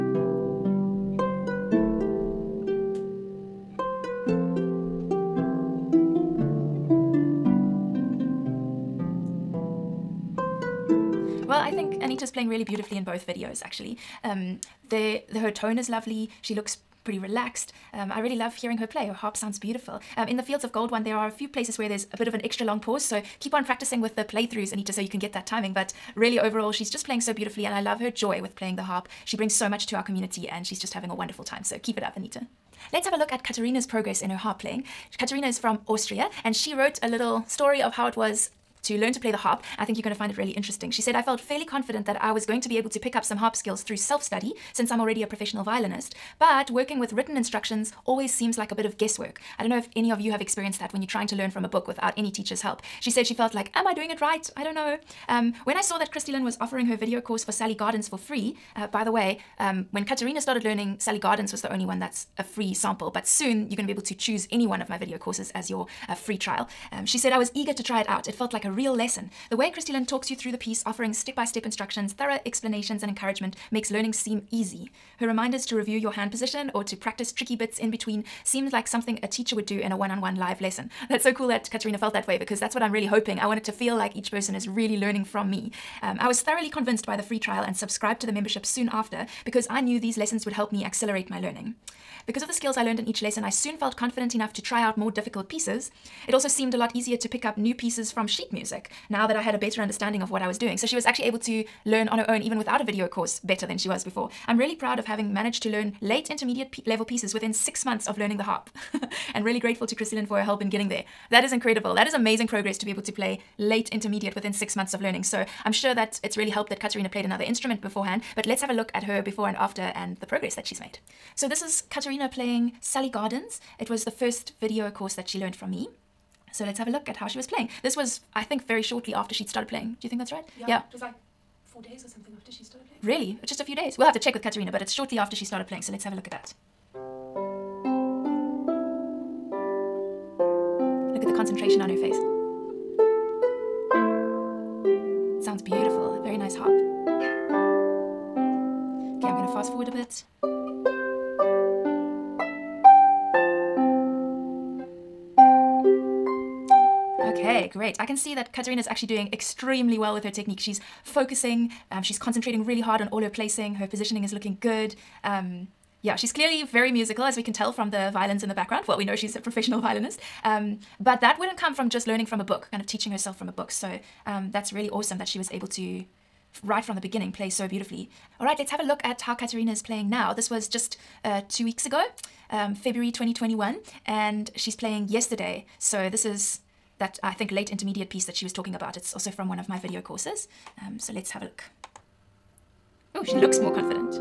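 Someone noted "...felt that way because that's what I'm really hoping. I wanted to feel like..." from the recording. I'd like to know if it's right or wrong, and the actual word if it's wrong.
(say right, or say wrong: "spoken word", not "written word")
right.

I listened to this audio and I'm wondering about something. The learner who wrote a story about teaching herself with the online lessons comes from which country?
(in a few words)
Austria.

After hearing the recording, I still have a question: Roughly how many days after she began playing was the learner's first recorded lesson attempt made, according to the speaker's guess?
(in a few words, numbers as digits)
4 days.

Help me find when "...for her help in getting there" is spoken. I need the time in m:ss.
1:50.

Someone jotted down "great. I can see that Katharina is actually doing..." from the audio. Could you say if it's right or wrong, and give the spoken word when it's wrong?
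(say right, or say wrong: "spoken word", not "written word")
right.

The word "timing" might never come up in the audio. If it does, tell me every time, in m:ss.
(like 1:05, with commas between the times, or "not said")
0:25.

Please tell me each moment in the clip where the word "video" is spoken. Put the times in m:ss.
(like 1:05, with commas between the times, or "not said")
0:13, 0:56, 1:04, 1:42, 2:04, 3:09.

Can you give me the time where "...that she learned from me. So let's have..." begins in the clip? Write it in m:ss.
2:05.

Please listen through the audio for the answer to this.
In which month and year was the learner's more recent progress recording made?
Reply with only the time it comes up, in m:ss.
3:02.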